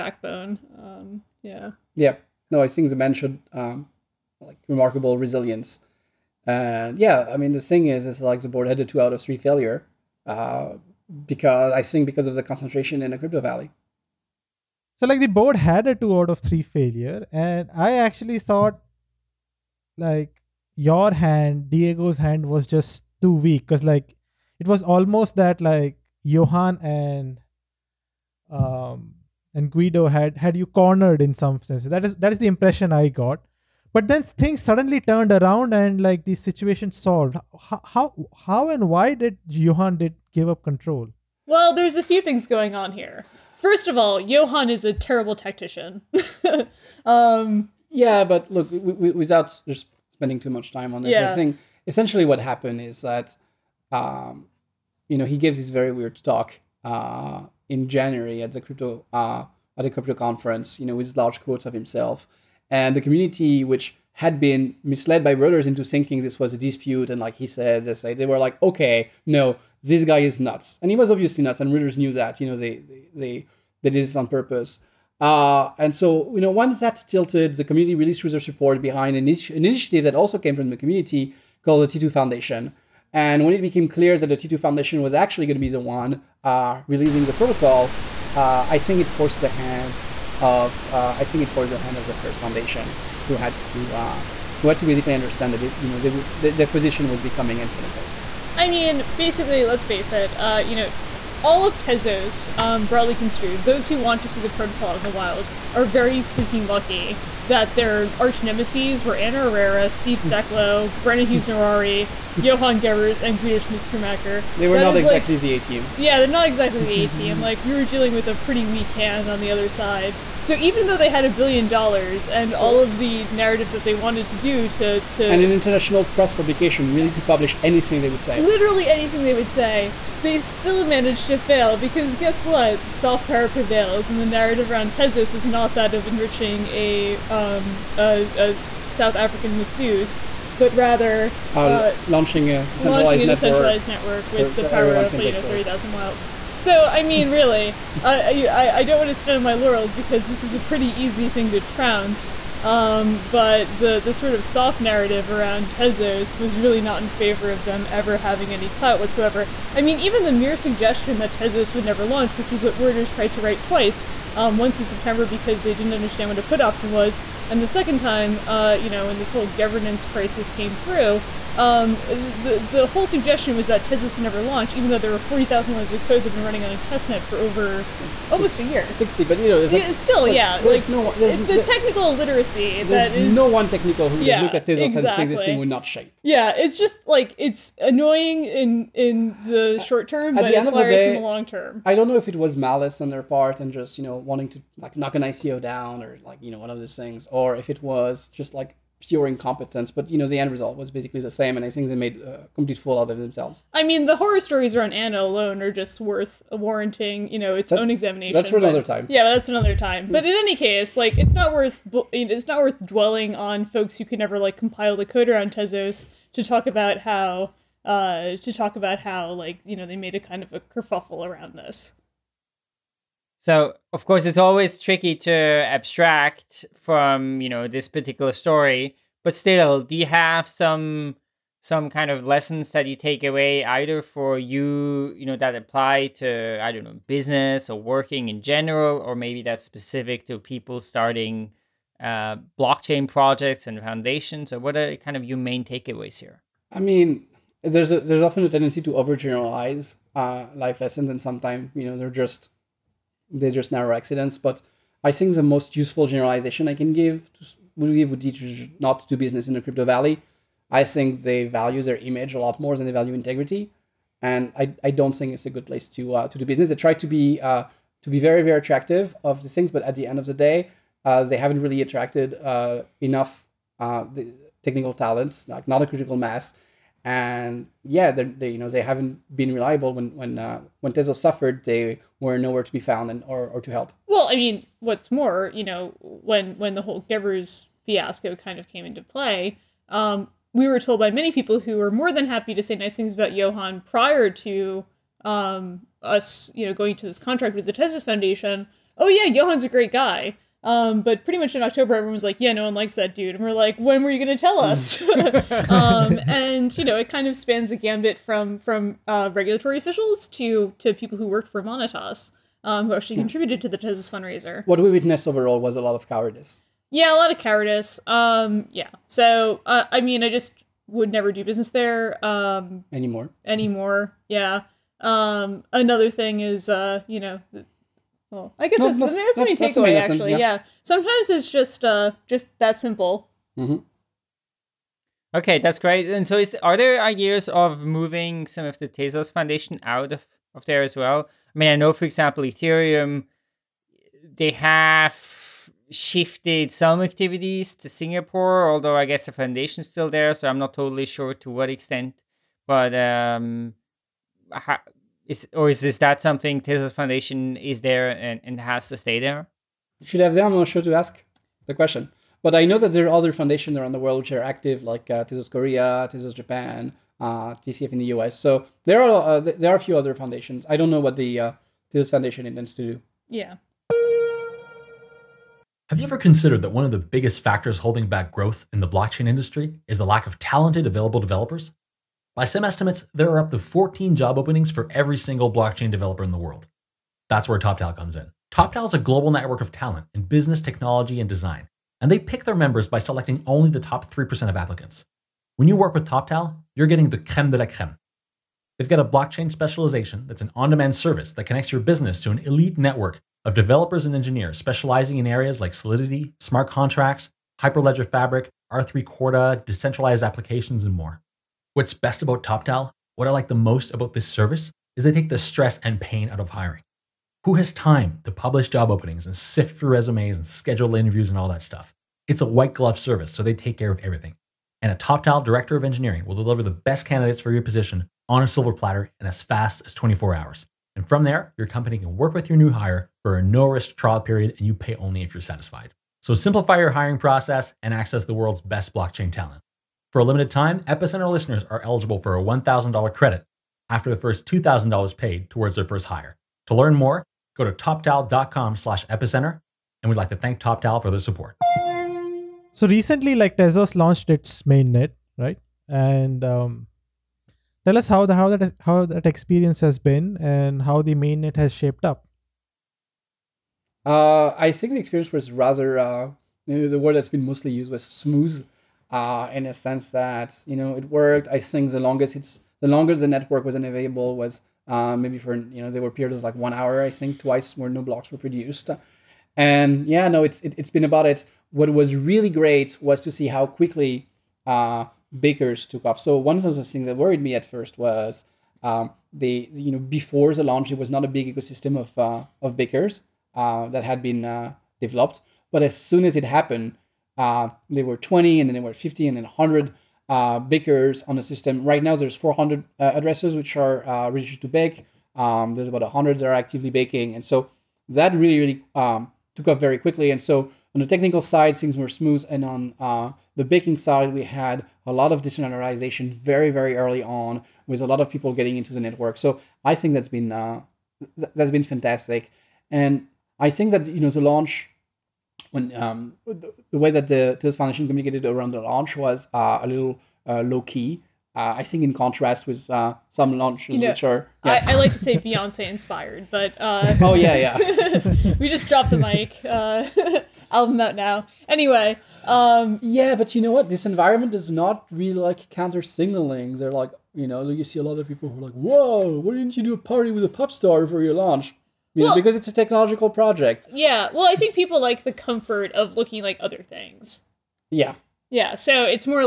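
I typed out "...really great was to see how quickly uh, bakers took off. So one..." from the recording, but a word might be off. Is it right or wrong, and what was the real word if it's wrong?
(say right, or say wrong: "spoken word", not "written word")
right.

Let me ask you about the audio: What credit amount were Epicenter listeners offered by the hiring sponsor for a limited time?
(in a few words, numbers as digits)
$1,000.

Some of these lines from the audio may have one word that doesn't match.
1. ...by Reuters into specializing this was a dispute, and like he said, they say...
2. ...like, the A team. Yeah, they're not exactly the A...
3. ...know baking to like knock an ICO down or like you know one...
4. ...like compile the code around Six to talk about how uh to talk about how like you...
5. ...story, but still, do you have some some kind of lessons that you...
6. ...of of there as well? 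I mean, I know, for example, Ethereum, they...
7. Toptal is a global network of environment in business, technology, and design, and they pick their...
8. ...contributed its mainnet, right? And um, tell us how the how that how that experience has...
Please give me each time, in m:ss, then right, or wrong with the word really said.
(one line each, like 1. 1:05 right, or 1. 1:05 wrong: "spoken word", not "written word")
1. 1:05 wrong: "thinking", not "specializing"
2. 1:55 right
3. 3:14 wrong: "wanting", not "baking"
4. 3:34 wrong: "Tezos", not "Six"
5. 3:48 right
6. 5:40 right
7. 6:28 wrong: "talent", not "environment"
8. 7:33 wrong: "launched", not "contributed".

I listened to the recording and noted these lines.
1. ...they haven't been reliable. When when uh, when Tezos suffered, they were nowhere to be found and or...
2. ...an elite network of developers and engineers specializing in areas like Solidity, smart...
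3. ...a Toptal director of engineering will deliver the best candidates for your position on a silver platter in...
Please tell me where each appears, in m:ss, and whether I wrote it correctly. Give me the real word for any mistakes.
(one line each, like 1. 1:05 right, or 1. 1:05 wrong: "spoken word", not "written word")
1. 4:38 right
2. 6:42 right
3. 7:04 right.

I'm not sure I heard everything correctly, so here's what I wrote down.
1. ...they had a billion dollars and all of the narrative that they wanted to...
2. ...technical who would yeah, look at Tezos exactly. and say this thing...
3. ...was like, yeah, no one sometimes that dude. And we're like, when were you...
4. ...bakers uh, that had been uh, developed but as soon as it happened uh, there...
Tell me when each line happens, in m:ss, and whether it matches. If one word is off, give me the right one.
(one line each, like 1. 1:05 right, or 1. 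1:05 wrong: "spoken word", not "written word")
1. 2:00 right
2. 3:03 right
3. 5:02 wrong: "likes", not "sometimes"
4. 8:12 right.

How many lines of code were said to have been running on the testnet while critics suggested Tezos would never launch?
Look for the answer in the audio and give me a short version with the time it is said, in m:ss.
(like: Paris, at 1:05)
40000, at 2:55.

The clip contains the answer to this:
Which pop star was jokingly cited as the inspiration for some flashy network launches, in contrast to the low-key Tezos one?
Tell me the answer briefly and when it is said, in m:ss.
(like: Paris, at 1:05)
Beyonce, at 8:55.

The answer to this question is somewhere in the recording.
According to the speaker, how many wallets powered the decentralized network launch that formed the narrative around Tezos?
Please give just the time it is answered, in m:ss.
2:25.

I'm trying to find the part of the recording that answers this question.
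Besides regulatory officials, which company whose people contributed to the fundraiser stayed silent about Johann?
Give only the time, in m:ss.
5:11.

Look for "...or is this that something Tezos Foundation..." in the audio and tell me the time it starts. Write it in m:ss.
5:55.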